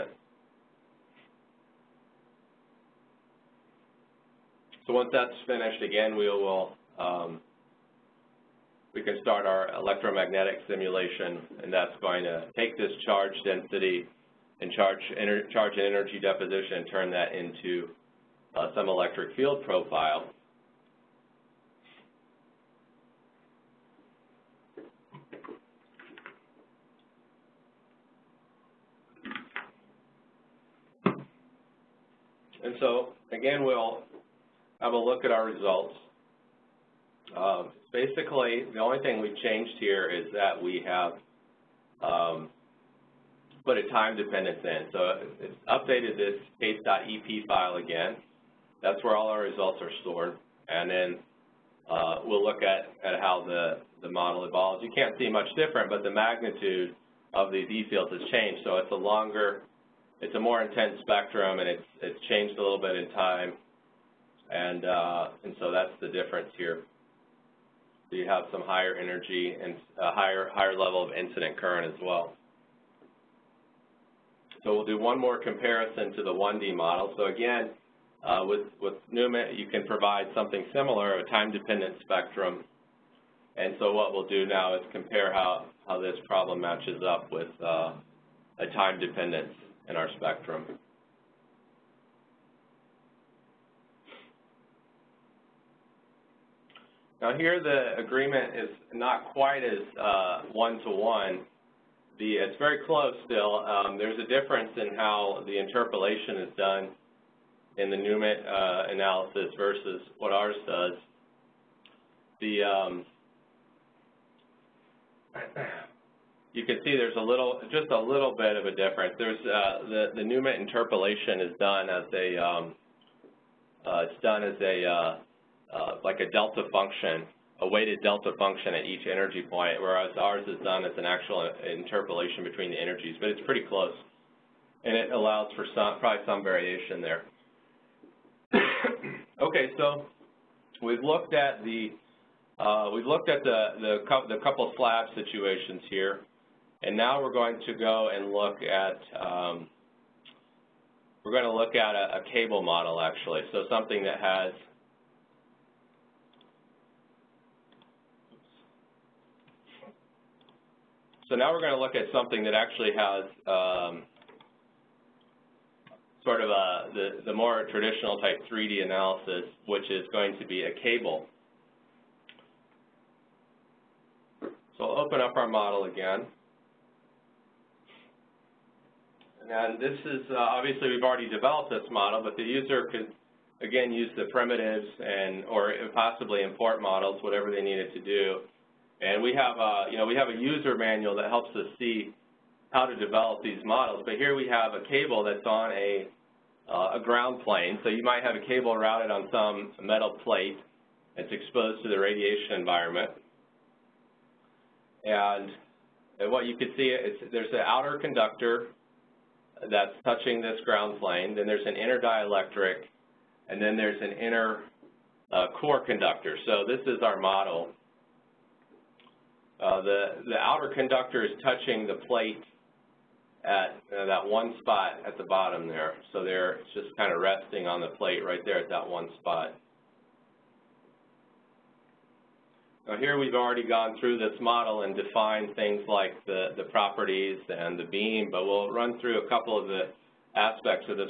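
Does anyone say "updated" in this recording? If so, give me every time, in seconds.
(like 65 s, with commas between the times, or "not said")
45 s.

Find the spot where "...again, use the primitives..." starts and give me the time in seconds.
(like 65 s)
183 s.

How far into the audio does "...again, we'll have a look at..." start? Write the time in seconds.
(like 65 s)
33 s.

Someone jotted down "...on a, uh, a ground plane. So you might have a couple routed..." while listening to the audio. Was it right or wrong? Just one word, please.
wrong.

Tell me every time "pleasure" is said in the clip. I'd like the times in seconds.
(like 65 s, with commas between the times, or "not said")
not said.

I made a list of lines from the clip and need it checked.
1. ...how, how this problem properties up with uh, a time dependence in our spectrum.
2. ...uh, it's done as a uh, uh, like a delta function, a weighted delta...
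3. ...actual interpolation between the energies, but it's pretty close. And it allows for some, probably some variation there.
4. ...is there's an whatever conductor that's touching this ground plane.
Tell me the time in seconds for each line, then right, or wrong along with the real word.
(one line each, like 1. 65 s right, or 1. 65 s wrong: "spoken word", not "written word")
1. 85 s wrong: "matches", not "properties"
2. 123 s right
3. 131 s right
4. 206 s wrong: "outer", not "whatever".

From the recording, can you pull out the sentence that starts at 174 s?
So I'll open up our model again.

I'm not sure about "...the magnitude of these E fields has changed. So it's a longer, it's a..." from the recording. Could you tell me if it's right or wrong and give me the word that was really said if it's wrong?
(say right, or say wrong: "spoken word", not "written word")
right.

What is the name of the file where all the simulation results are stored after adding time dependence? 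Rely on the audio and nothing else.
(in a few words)
case.ep.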